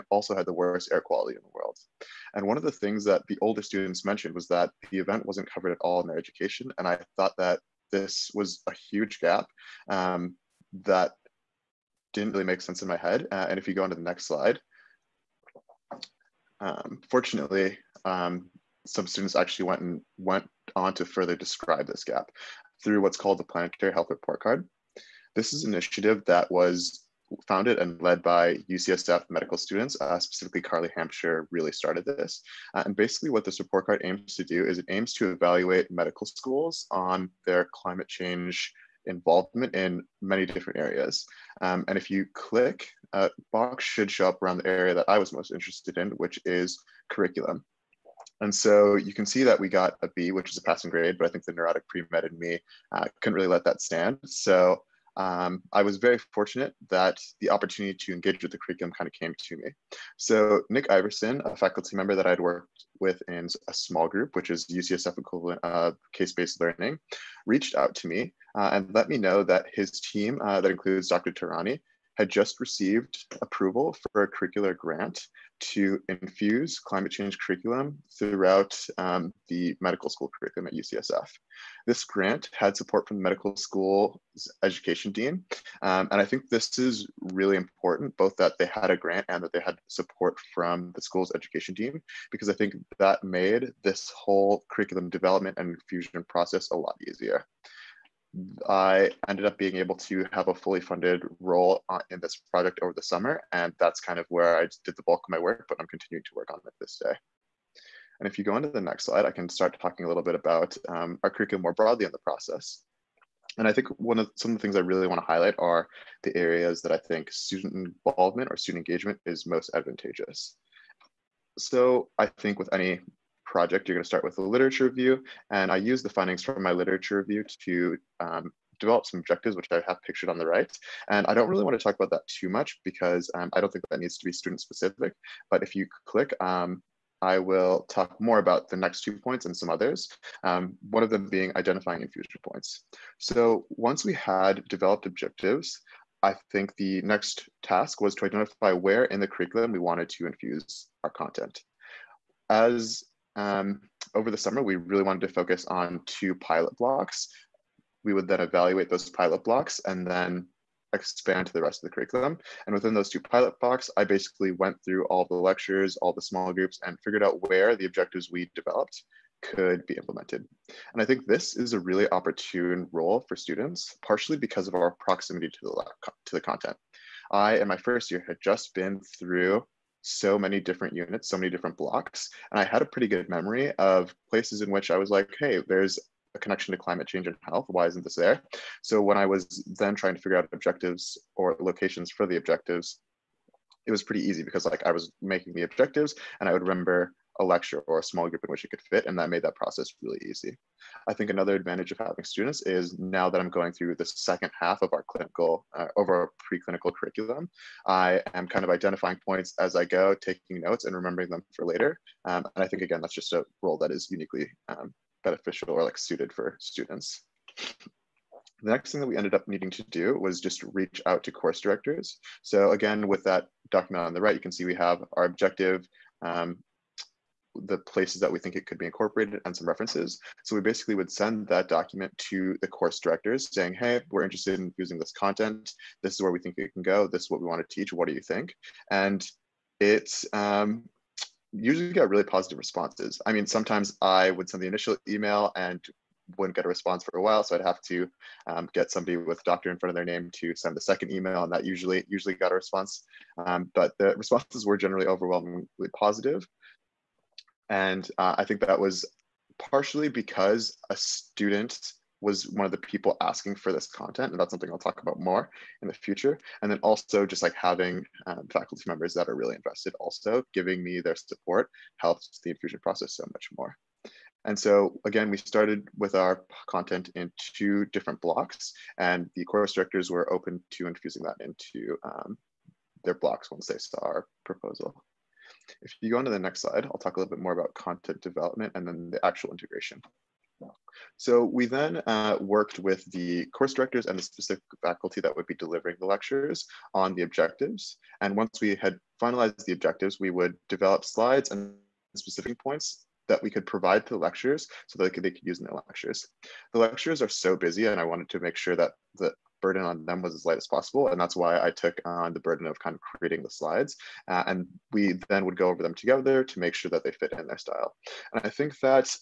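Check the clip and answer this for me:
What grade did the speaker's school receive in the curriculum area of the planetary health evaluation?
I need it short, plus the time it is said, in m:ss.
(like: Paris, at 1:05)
B, at 0:50.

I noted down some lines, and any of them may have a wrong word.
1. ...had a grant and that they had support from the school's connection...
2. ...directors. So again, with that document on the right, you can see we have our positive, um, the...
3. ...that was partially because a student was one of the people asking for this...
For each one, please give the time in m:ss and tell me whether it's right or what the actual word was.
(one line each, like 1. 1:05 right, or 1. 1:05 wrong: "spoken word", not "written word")
1. 1:28 wrong: "education", not "connection"
2. 3:41 wrong: "objective", not "positive"
3. 4:18 right.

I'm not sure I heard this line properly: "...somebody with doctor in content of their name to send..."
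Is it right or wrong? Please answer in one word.
wrong.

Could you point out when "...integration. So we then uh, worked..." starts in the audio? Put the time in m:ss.
4:49.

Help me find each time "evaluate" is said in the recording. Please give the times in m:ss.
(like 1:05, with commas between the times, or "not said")
0:35, 2:38.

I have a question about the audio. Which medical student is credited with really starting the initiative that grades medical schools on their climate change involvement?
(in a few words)
Carly Hampshire.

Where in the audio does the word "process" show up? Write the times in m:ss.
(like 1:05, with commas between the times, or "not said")
1:36, 1:52, 3:19, 4:32.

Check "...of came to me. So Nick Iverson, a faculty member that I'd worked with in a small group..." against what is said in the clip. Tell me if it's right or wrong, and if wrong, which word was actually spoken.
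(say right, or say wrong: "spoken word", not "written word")
right.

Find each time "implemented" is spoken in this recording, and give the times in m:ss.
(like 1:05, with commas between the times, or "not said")
2:49.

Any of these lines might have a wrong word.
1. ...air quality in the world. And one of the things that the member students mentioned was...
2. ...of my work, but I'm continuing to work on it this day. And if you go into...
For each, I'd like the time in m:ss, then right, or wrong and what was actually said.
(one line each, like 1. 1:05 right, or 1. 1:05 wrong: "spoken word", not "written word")
1. 0:00 wrong: "older", not "member"
2. 1:45 right.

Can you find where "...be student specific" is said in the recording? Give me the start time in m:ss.
2:14.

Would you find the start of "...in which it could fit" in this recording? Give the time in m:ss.
3:18.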